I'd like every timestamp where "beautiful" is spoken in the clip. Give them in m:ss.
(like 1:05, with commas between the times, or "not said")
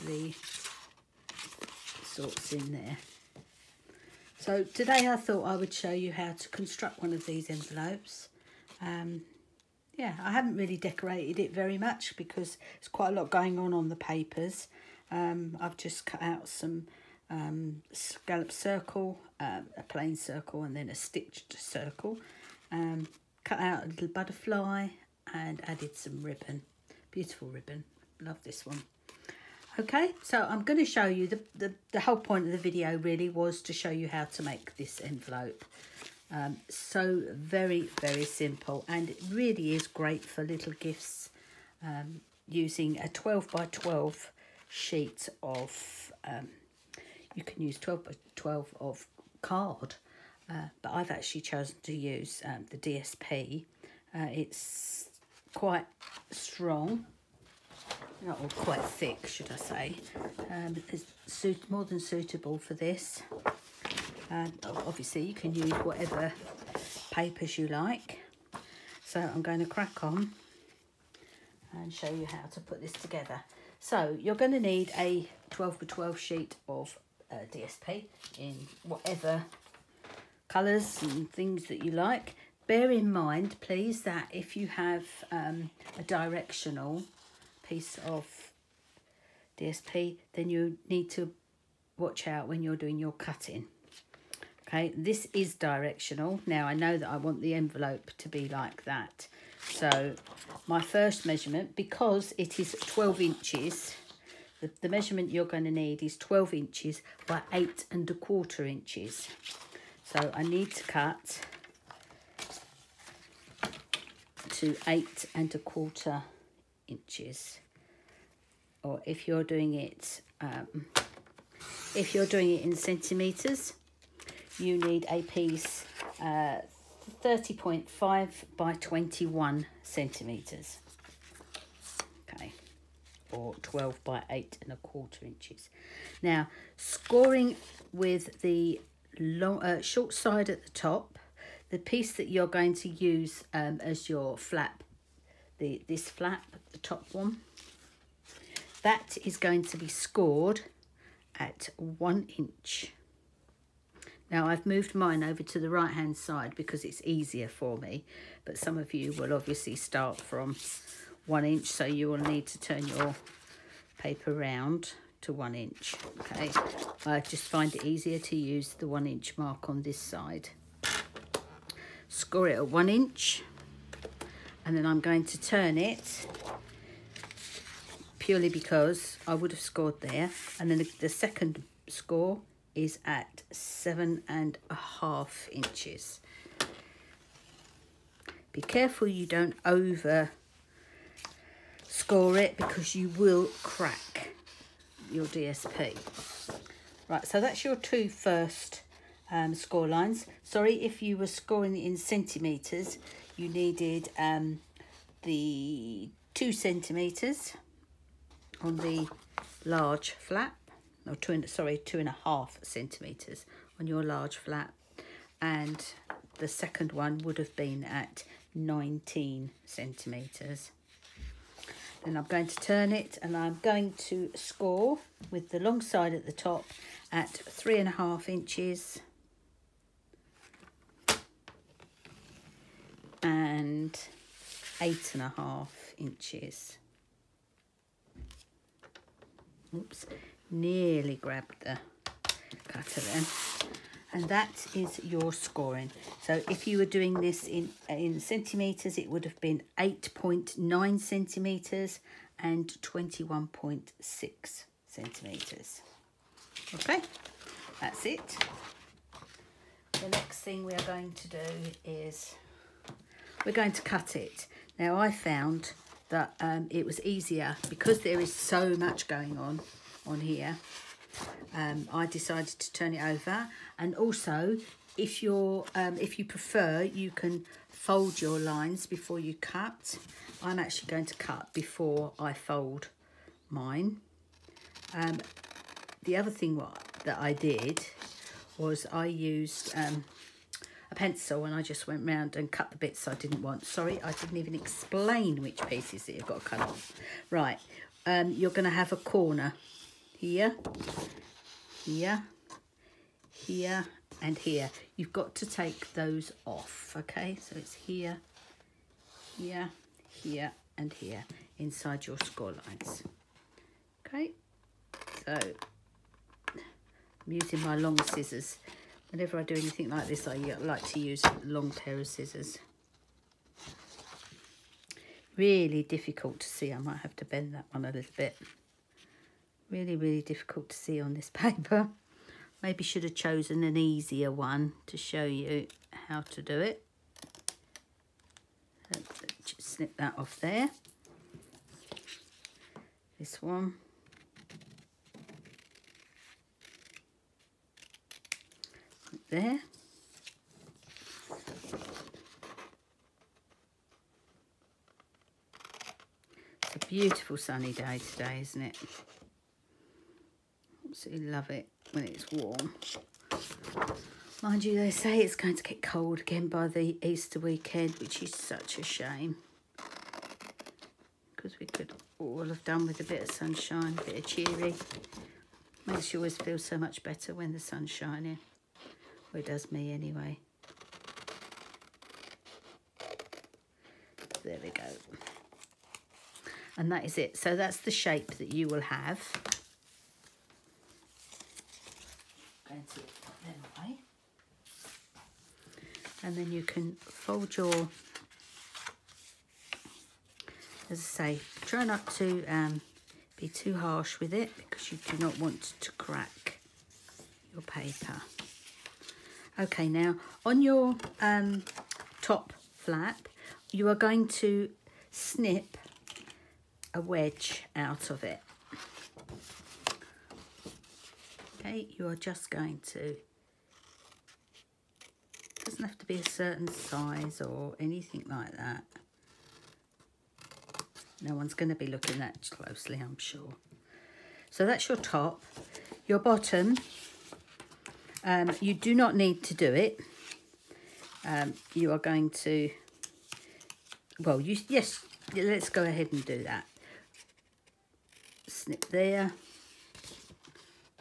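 0:27, 5:56.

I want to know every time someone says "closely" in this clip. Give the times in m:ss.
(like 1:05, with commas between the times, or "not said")
7:12.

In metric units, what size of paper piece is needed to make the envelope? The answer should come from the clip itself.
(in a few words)
30.5 by 21 centimetres.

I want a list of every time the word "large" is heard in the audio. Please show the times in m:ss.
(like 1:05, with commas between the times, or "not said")
3:29, 3:34.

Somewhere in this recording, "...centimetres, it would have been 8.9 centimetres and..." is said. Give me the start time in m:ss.
4:08.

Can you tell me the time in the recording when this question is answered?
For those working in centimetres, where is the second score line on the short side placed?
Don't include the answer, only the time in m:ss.
3:38.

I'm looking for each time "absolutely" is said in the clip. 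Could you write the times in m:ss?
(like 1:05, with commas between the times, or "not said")
6:00.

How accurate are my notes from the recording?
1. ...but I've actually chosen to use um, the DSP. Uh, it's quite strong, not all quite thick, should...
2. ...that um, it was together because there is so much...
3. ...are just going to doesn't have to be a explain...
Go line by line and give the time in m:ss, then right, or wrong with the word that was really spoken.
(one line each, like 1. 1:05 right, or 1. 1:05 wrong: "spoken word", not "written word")
1. 0:50 right
2. 4:26 wrong: "easier", not "together"
3. 7:02 wrong: "certain", not "explain".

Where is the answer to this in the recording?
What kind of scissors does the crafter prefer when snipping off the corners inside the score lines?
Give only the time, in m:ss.
5:17.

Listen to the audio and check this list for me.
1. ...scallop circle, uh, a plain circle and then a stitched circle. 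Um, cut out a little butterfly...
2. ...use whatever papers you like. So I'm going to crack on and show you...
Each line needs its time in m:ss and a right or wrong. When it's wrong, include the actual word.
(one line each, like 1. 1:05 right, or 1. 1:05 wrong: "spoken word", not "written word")
1. 0:17 right
2. 1:05 right.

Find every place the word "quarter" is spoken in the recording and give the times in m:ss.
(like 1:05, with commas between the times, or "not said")
1:48, 1:55, 2:14.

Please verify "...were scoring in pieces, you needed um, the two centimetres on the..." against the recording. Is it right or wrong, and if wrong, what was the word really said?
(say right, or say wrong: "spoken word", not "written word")
wrong: "centimetres", not "pieces".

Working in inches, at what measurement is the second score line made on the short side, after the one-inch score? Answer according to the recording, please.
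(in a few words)
7 and a half inches.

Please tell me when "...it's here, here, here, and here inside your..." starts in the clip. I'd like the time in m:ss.
5:07.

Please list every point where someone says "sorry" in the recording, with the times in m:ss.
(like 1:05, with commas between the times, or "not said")
3:20, 3:31, 4:53.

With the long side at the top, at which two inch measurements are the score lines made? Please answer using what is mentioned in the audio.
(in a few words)
3 and a half and 8 and a half inches.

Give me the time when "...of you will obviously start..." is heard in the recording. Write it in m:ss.
2:38.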